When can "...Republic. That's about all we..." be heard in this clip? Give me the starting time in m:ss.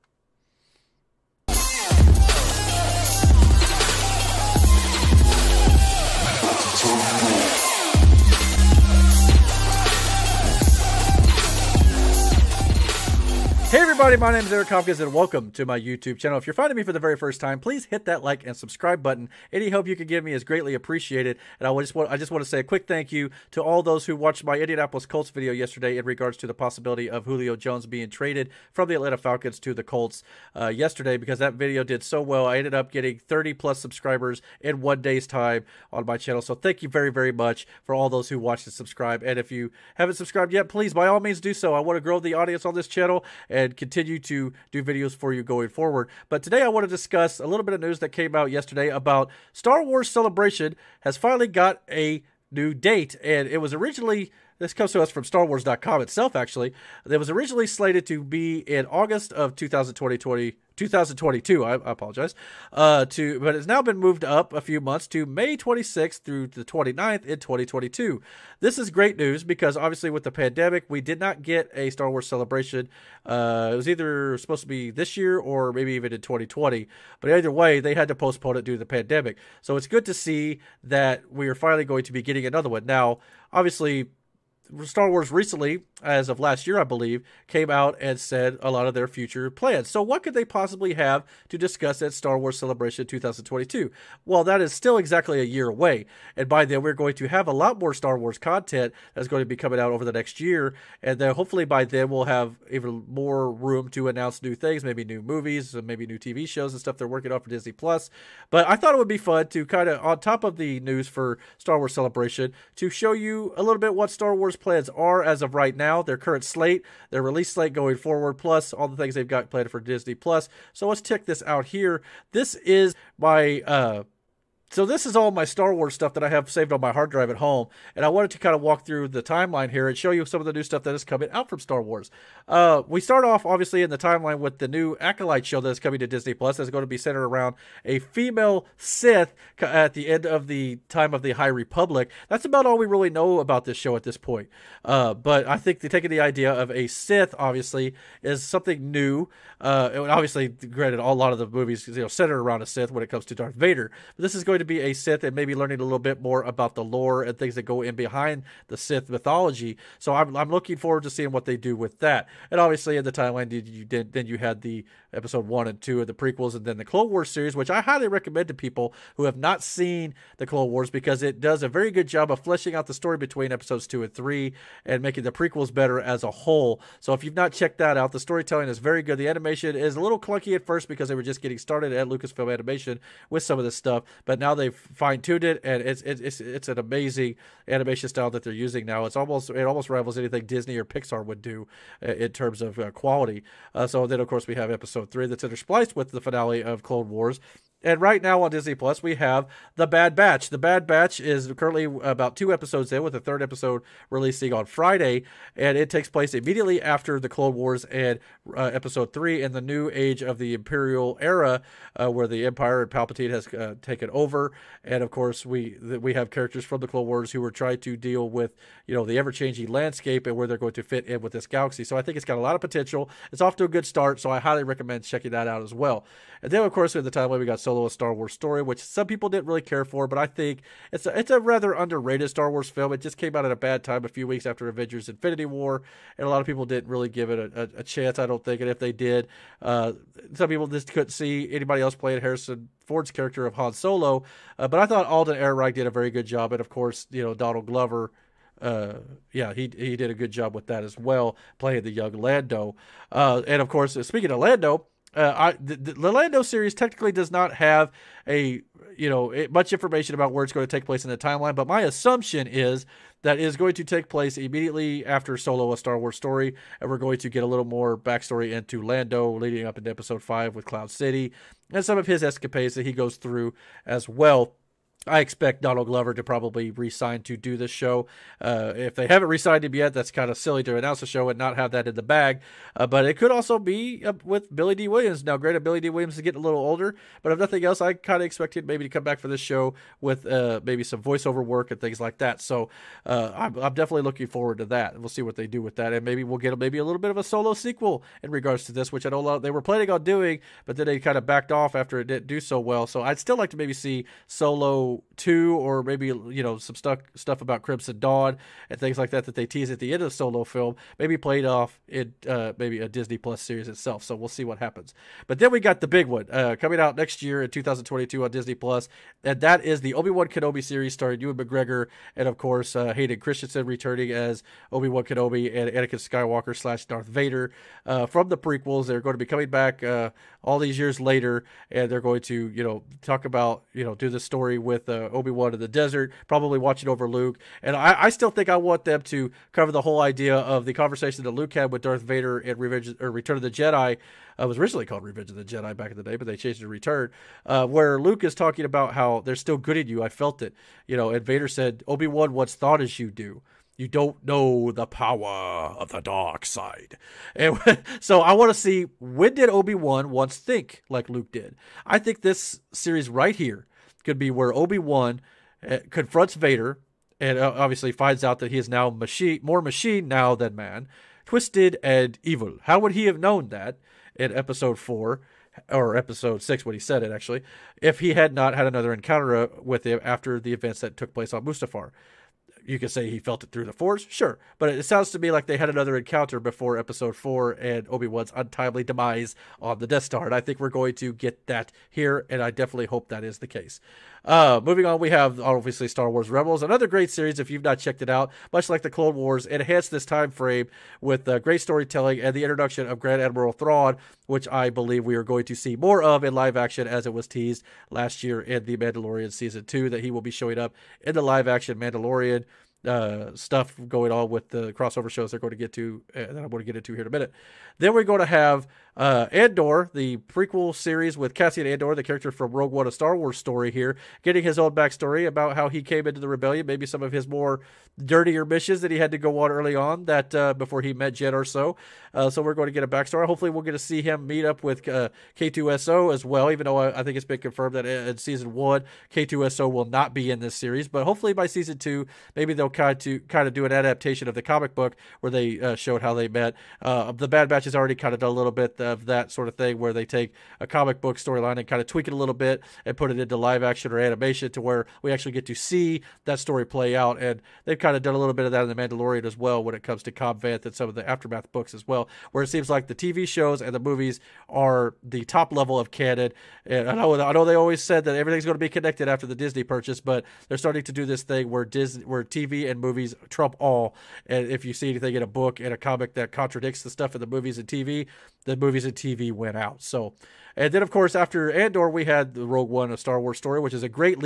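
2:21.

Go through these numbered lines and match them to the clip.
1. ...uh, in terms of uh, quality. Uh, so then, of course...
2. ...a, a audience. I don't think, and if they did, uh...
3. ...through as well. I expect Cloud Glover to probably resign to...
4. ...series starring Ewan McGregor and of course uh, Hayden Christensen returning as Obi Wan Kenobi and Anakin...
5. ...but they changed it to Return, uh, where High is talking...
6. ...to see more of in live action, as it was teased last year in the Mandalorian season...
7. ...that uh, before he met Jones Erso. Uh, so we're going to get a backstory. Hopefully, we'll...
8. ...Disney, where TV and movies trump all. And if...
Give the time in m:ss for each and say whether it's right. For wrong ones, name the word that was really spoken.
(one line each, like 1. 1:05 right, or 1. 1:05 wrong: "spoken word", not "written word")
1. 3:12 right
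2. 3:57 wrong: "chance", not "audience"
3. 4:33 wrong: "Donald", not "Cloud"
4. 5:20 right
5. 5:46 wrong: "Luke", not "High"
6. 6:45 right
7. 7:10 wrong: "Jyn", not "Jones"
8. 7:51 right.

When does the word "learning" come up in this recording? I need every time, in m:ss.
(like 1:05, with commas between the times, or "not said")
2:35.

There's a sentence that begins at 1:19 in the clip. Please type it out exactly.
So it's good to see that we are finally going to be getting another one.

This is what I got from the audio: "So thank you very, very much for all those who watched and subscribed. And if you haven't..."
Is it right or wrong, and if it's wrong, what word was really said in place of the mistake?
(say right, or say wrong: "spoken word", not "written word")
right.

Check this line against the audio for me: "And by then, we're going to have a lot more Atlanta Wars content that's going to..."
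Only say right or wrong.
wrong.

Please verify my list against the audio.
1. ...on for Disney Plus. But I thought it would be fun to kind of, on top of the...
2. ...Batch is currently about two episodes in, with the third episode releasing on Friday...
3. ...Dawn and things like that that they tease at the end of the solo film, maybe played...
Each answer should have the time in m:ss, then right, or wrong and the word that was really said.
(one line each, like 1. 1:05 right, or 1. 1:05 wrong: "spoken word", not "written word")
1. 1:47 right
2. 3:20 right
3. 5:07 right.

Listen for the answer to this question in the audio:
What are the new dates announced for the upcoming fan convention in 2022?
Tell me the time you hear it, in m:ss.
1:05.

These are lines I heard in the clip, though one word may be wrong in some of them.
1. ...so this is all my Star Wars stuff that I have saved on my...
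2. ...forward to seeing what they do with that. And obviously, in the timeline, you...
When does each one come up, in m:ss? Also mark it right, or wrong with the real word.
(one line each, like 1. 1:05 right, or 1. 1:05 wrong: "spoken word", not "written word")
1. 2:04 right
2. 2:40 right.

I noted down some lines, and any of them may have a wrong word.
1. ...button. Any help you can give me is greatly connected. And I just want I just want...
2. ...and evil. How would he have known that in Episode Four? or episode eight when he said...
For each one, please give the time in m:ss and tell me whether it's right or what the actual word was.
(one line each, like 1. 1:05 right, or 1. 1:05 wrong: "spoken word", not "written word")
1. 0:19 wrong: "appreciated", not "connected"
2. 6:11 wrong: "six", not "eight".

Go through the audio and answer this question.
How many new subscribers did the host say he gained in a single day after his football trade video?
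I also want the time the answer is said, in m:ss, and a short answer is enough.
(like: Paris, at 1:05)
30 plus, at 0:33.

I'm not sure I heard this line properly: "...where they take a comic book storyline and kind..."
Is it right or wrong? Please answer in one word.
right.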